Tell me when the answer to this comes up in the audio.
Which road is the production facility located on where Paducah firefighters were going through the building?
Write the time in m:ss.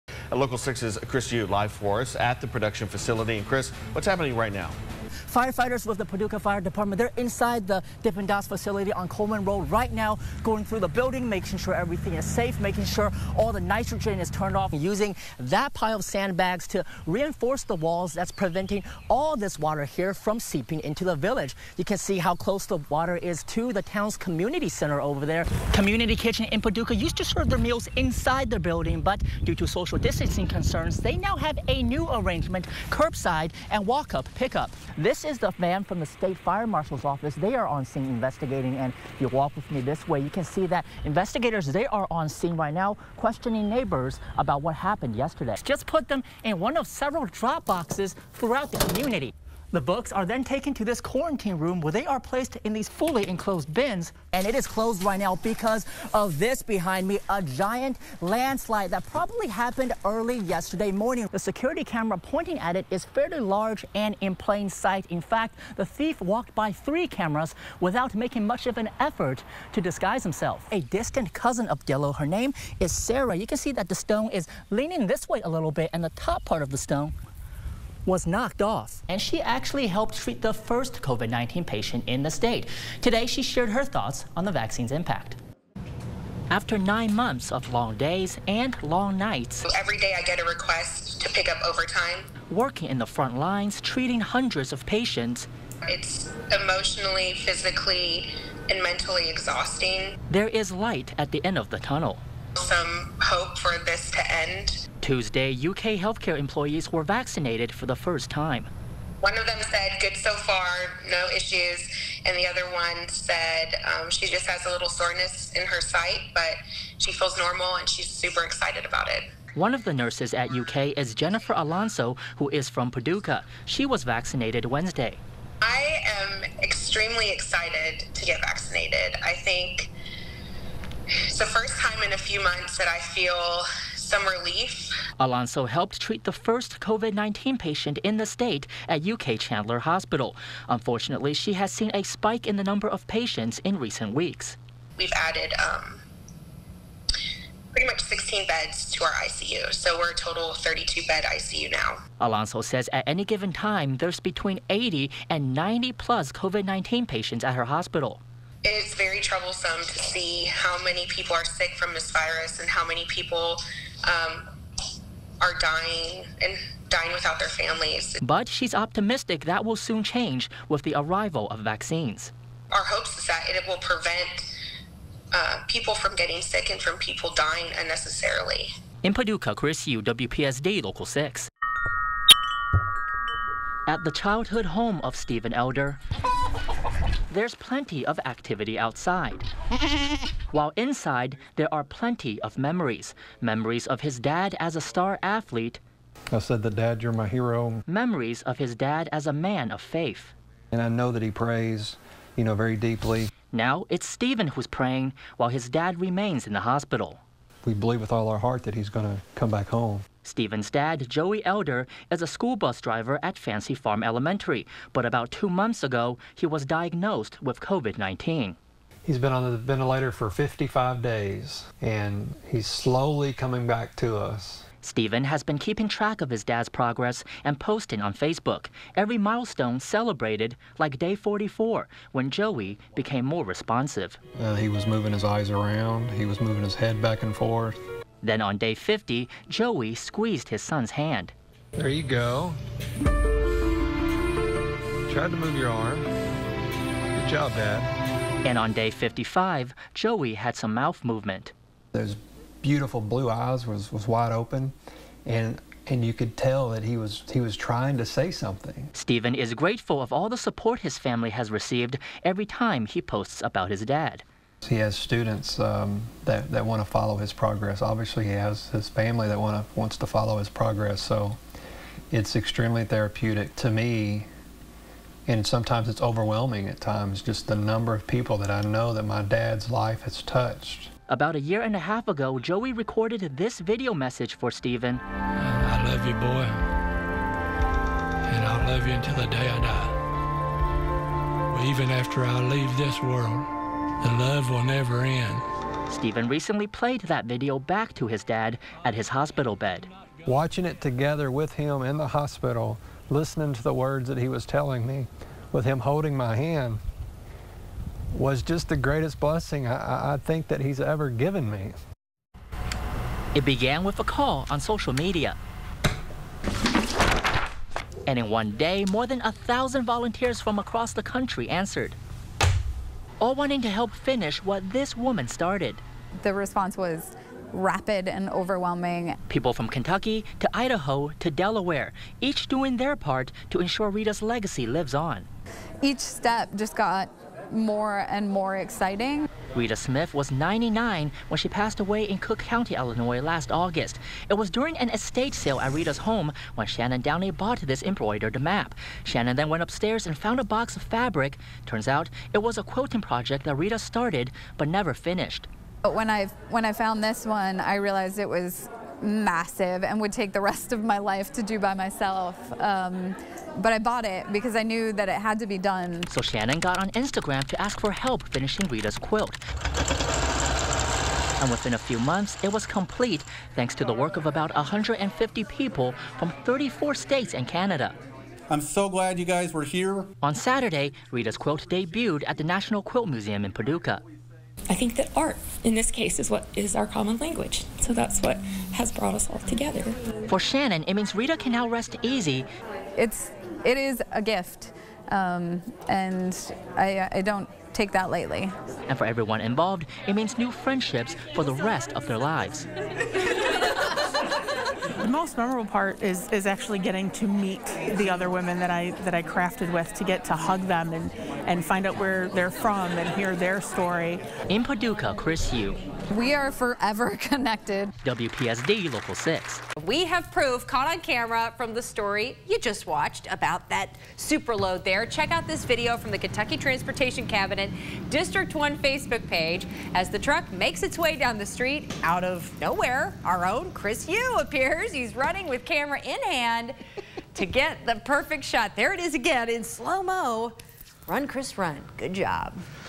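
0:09.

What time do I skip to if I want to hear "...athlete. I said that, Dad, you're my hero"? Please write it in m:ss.
3:15.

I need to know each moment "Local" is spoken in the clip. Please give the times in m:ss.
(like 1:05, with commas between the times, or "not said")
0:00, 3:00, 6:58.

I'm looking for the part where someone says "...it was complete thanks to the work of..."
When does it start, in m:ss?
6:12.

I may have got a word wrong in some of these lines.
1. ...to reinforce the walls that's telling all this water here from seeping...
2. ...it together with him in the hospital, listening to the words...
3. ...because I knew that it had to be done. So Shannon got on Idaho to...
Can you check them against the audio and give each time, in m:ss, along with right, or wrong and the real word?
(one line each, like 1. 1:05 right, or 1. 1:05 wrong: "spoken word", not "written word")
1. 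0:16 wrong: "preventing", not "telling"
2. 5:00 right
3. 6:04 wrong: "Instagram", not "Idaho".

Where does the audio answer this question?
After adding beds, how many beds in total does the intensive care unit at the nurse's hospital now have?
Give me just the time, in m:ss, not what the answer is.
2:30.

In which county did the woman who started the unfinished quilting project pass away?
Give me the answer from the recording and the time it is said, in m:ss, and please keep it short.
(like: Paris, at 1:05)
Cook County, at 5:42.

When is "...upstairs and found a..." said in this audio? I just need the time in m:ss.
5:49.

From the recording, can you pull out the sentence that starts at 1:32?
Working in the front lines, treating hundreds of patients.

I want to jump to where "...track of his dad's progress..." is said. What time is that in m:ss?
3:45.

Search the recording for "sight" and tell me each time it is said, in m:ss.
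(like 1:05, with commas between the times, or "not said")
1:04, 1:55.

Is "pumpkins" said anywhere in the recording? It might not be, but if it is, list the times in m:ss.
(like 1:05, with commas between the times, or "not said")
not said.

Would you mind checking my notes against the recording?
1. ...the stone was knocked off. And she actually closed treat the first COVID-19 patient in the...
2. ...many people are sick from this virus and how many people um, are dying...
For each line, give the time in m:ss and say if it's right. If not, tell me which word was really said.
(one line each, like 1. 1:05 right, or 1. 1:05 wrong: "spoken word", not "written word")
1. 1:16 wrong: "helped", not "closed"
2. 2:40 right.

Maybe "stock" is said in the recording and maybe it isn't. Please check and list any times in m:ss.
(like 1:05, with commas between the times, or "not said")
not said.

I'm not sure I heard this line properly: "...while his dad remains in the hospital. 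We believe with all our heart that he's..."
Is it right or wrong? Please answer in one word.
right.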